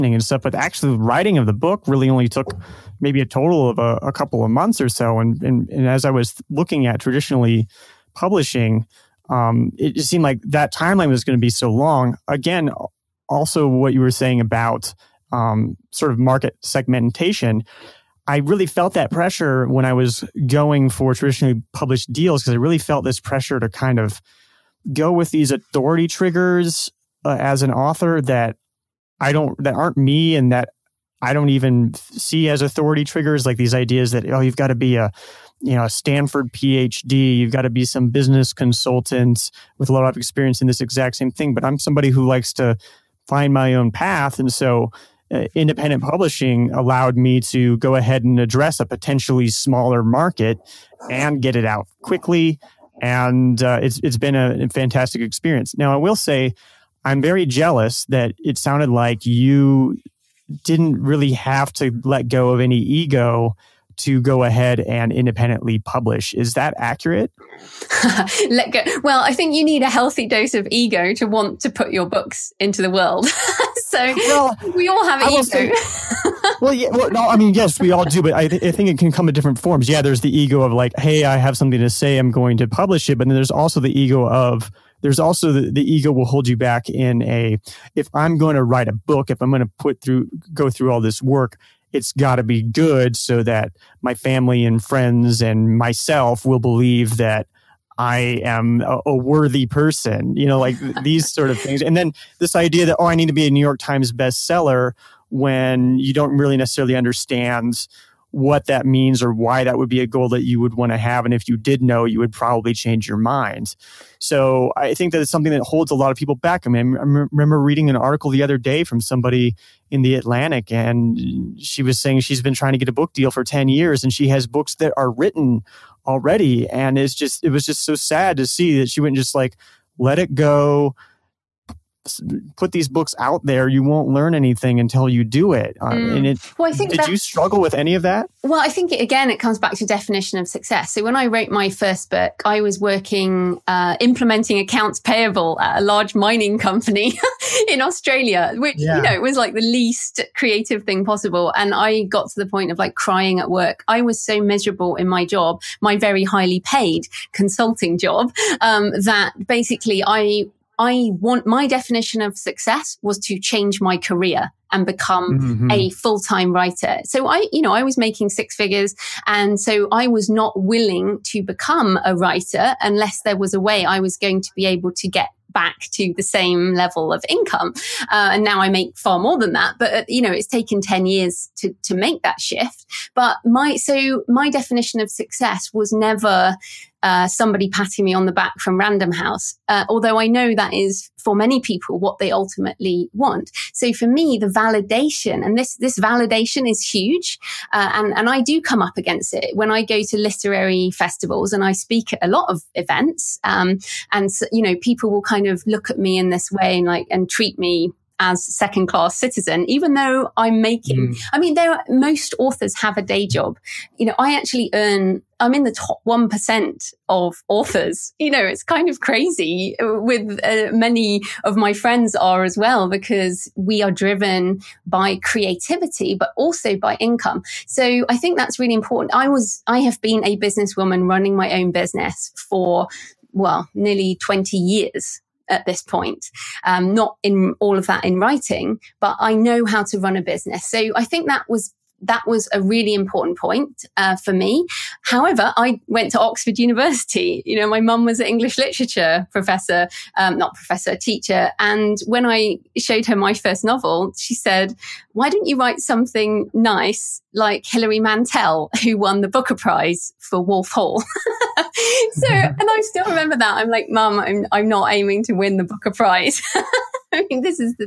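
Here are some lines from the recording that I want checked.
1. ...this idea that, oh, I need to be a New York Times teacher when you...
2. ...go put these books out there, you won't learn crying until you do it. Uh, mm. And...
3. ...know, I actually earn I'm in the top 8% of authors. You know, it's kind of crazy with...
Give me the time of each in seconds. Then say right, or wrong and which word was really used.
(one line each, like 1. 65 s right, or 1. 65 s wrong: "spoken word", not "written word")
1. 102 s wrong: "bestseller", not "teacher"
2. 130 s wrong: "anything", not "crying"
3. 214 s wrong: "1", not "8".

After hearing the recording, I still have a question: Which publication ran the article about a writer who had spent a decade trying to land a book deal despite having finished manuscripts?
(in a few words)
The Atlantic.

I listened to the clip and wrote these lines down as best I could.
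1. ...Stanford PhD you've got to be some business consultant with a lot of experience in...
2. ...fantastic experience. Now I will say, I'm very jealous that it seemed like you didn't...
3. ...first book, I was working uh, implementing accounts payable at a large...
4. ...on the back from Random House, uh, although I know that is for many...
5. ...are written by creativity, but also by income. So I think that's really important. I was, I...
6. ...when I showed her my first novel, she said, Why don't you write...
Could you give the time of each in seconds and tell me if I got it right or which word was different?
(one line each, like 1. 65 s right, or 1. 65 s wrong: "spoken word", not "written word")
1. 35 s right
2. 54 s wrong: "sounded", not "seemed"
3. 141 s right
4. 188 s right
5. 223 s wrong: "driven", not "written"
6. 252 s right.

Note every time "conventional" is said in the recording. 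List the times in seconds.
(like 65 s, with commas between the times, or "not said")
not said.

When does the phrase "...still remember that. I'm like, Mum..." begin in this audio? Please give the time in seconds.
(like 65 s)
262 s.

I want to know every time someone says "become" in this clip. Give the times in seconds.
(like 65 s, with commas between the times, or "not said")
164 s, 171 s.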